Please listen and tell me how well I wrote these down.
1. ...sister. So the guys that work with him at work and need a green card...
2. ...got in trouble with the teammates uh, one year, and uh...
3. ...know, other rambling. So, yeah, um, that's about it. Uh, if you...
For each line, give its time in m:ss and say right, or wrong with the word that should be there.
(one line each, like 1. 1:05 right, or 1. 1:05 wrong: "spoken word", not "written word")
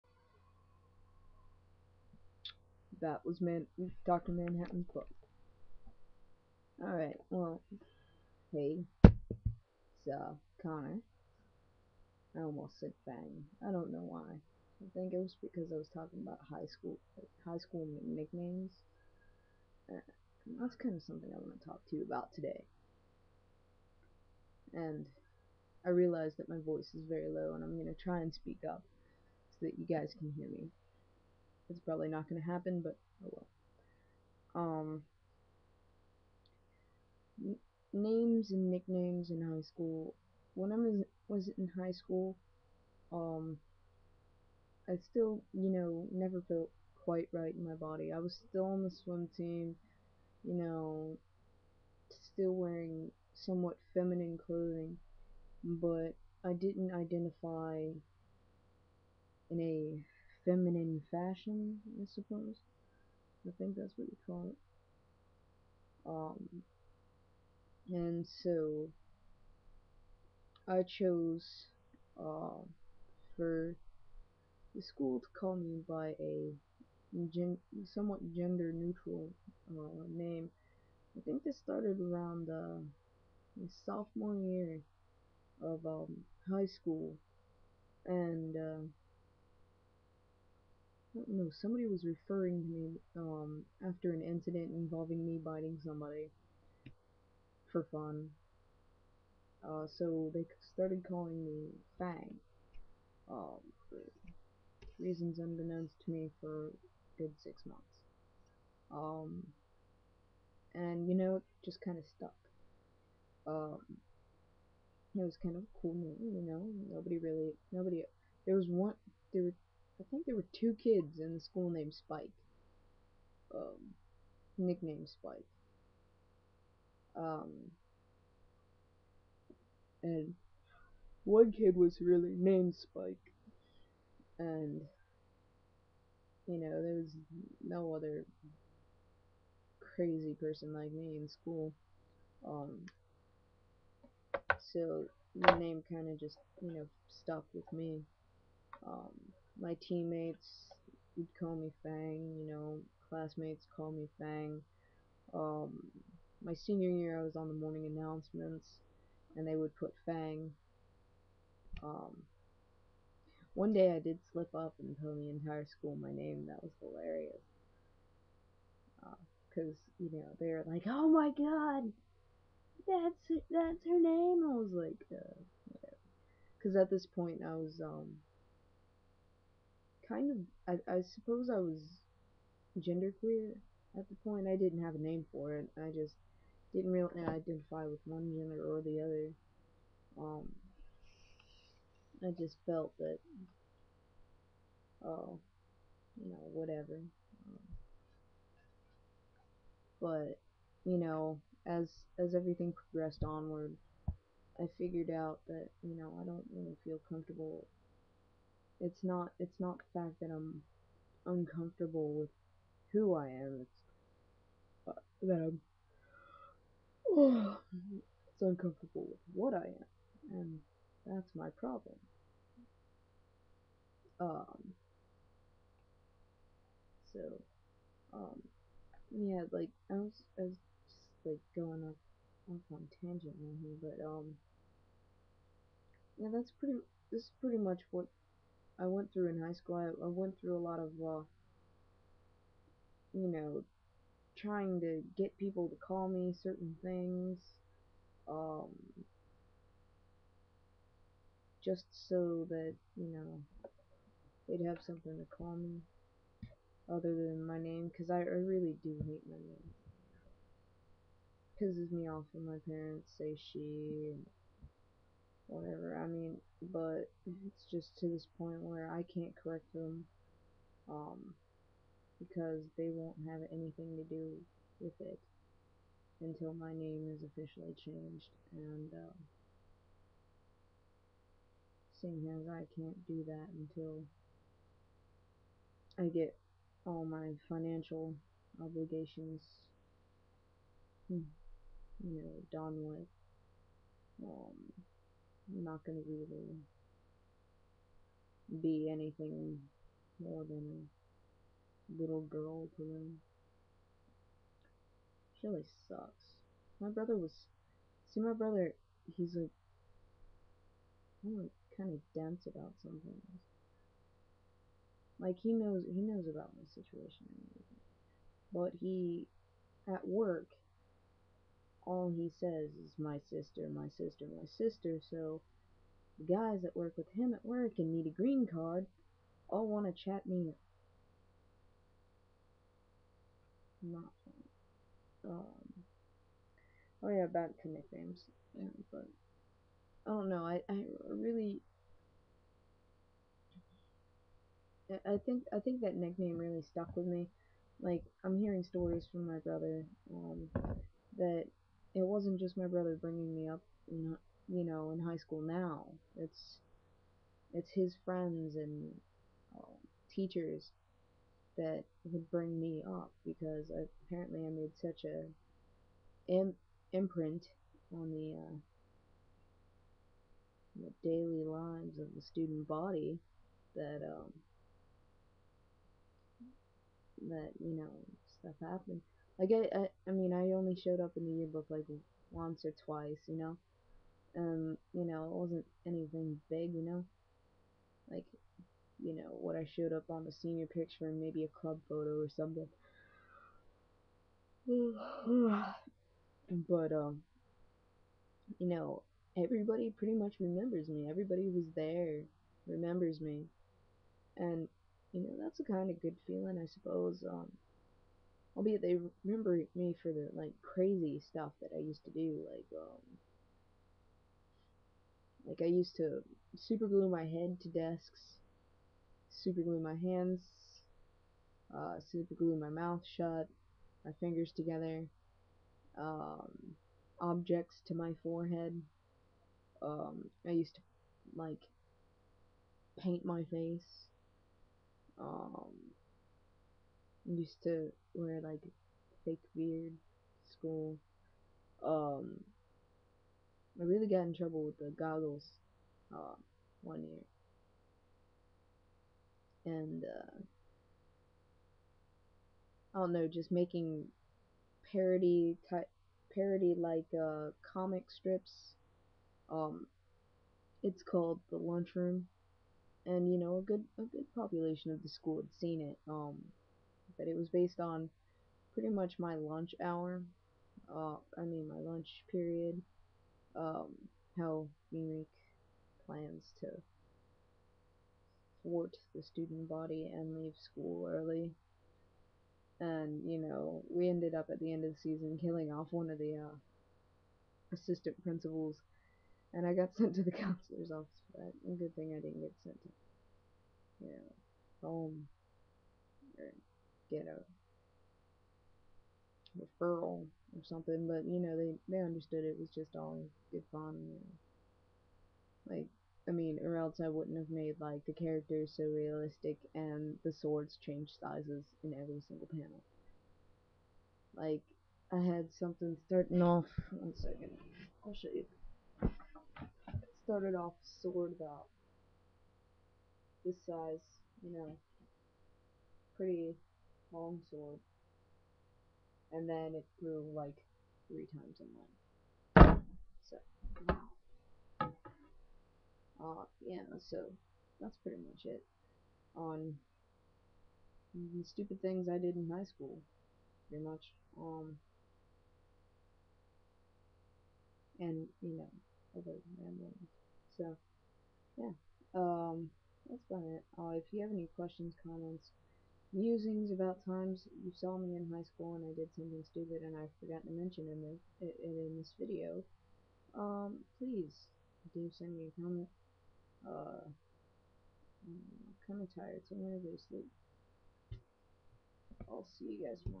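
1. 5:24 right
2. 7:24 wrong: "goggles", not "teammates"
3. 9:08 right.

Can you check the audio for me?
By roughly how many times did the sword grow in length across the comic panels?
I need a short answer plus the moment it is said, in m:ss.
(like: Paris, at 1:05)
3 times, at 8:51.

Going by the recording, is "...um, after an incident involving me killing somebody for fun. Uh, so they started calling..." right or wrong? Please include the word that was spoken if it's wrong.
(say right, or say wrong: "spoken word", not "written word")
wrong: "biting", not "killing".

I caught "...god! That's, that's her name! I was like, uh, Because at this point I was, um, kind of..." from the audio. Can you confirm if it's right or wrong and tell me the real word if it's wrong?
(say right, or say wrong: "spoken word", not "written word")
right.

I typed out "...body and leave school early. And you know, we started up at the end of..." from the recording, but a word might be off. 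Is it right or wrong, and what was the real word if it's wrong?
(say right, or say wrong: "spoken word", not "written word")
wrong: "ended", not "started".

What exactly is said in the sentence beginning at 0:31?
It's probably not going to happen, but oh well.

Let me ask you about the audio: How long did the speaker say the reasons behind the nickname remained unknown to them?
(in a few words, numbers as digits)
6 months.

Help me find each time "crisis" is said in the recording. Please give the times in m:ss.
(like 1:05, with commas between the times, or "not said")
not said.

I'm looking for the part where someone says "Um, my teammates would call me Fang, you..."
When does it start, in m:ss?
2:28.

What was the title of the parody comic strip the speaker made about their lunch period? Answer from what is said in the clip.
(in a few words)
The Lunchroom.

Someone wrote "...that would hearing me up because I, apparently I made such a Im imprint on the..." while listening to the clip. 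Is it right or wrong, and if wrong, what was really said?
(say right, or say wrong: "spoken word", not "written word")
wrong: "bring", not "hearing".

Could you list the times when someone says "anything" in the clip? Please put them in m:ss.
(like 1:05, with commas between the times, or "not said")
4:33, 4:58, 6:25.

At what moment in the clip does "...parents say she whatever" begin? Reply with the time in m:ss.
4:22.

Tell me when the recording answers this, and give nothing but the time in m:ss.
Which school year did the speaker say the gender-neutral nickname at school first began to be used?
1:23.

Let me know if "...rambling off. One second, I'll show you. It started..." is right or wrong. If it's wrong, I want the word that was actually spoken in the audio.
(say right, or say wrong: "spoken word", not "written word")
wrong: "starting", not "rambling".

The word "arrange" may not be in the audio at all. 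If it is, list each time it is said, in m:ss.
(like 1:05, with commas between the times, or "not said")
not said.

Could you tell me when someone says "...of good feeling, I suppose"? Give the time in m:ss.
6:45.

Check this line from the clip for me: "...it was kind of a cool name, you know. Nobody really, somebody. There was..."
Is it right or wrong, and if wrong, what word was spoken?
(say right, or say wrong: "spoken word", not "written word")
wrong: "nobody", not "somebody".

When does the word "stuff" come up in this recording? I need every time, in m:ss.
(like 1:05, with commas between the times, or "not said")
6:18, 6:51.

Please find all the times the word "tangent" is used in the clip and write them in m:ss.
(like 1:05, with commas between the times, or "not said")
3:52.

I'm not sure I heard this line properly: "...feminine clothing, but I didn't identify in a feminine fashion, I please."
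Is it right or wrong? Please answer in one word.
wrong.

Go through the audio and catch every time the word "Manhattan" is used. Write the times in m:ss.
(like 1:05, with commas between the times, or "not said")
0:04.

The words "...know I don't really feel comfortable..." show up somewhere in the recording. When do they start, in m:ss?
3:25.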